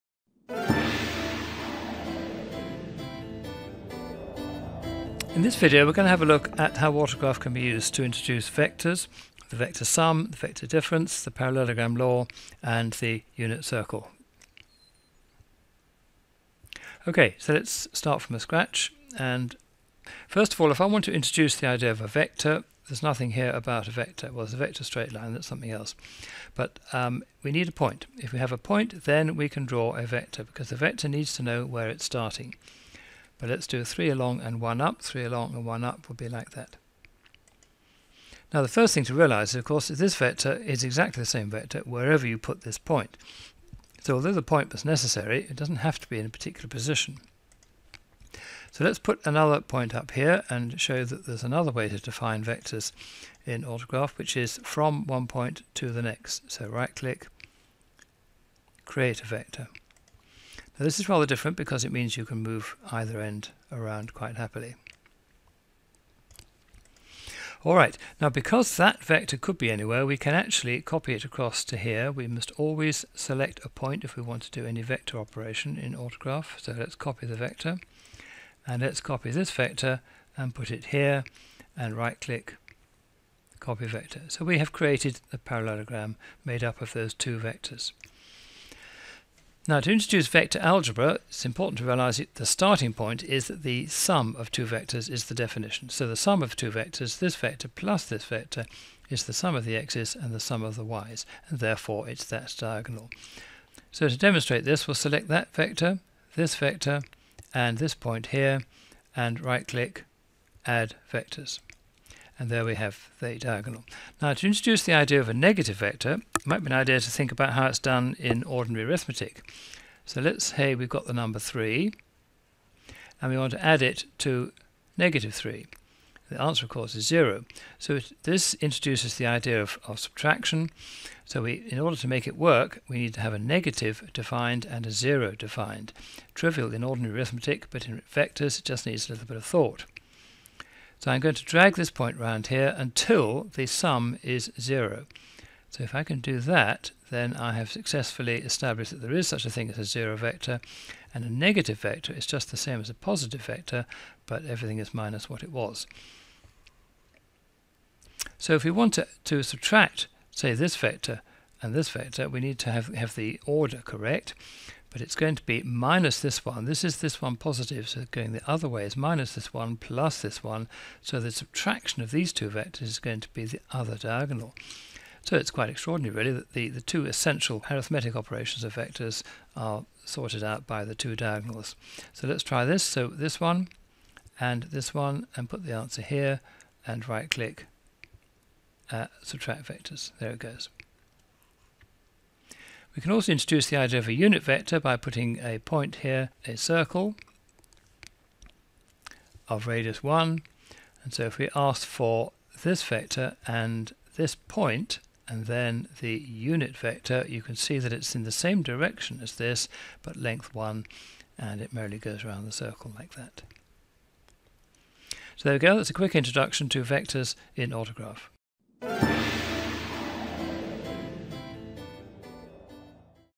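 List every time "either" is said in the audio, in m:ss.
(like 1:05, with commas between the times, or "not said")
1:02.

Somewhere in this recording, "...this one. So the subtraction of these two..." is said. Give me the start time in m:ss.
2:50.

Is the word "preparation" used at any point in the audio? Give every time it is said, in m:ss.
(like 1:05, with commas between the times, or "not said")
not said.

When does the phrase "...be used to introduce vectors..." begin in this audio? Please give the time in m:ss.
0:07.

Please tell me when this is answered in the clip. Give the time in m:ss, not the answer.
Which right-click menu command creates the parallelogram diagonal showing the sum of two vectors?
1:50.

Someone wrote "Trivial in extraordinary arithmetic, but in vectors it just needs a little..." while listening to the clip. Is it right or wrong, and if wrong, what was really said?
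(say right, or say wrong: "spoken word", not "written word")
wrong: "ordinary", not "extraordinary".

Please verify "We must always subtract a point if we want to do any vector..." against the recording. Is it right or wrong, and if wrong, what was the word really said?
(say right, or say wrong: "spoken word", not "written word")
wrong: "select", not "subtract".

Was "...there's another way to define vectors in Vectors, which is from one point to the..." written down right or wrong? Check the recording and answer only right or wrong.
wrong.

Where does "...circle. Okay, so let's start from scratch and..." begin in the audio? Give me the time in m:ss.
0:13.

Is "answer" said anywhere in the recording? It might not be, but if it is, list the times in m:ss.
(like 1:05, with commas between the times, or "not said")
2:06, 3:05.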